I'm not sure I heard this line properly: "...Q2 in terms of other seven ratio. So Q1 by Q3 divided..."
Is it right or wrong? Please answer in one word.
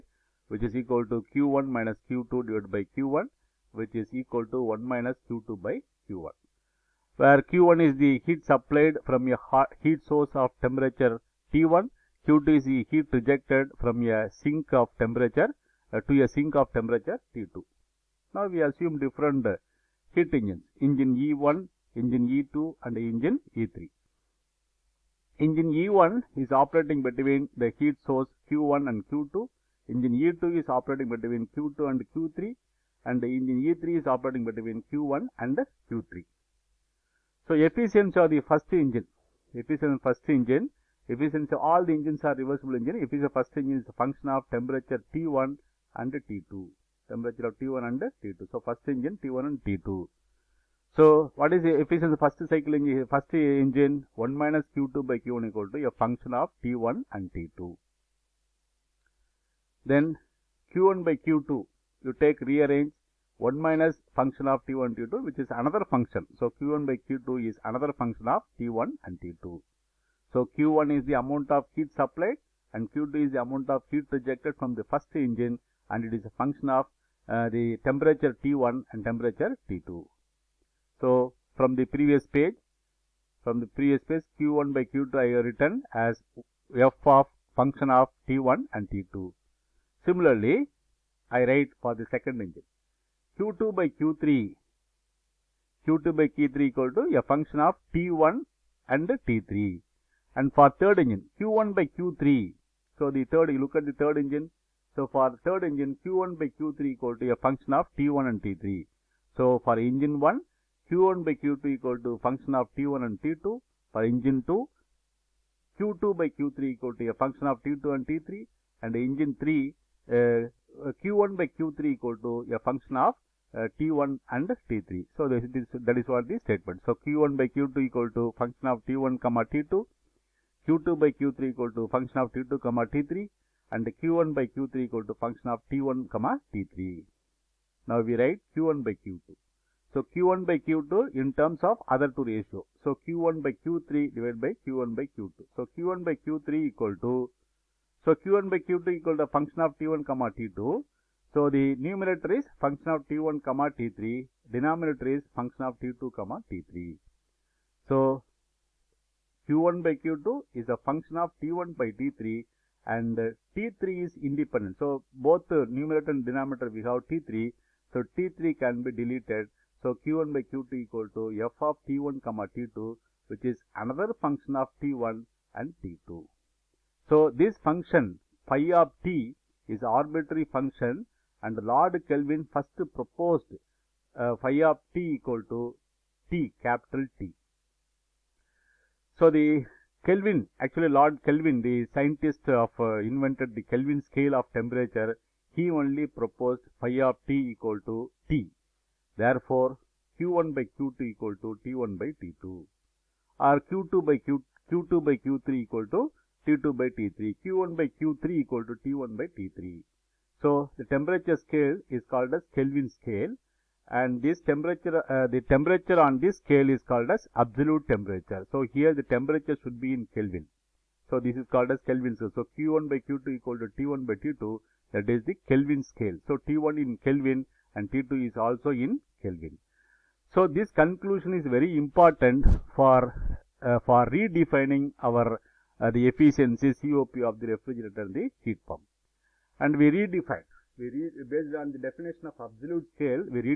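wrong.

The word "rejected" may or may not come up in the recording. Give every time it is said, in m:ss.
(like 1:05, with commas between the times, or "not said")
0:13, 1:14.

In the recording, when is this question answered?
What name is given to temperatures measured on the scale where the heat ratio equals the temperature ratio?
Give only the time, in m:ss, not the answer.
3:37.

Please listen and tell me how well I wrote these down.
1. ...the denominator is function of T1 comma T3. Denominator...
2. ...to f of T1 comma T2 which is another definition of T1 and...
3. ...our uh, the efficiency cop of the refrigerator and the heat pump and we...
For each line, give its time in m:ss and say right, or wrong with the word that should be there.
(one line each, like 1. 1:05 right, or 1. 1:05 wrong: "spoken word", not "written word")
1. 2:31 wrong: "numerator", not "denominator"
2. 2:51 wrong: "function", not "definition"
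3. 3:55 right.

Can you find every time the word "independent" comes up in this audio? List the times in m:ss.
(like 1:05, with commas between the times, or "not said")
2:44.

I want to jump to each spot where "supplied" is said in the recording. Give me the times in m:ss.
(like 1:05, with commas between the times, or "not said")
0:08, 1:11.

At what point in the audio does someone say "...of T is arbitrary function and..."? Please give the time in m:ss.
2:58.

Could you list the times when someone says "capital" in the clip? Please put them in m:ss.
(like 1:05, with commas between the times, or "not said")
3:06.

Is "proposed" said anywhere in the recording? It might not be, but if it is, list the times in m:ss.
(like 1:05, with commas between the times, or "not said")
3:02, 3:16.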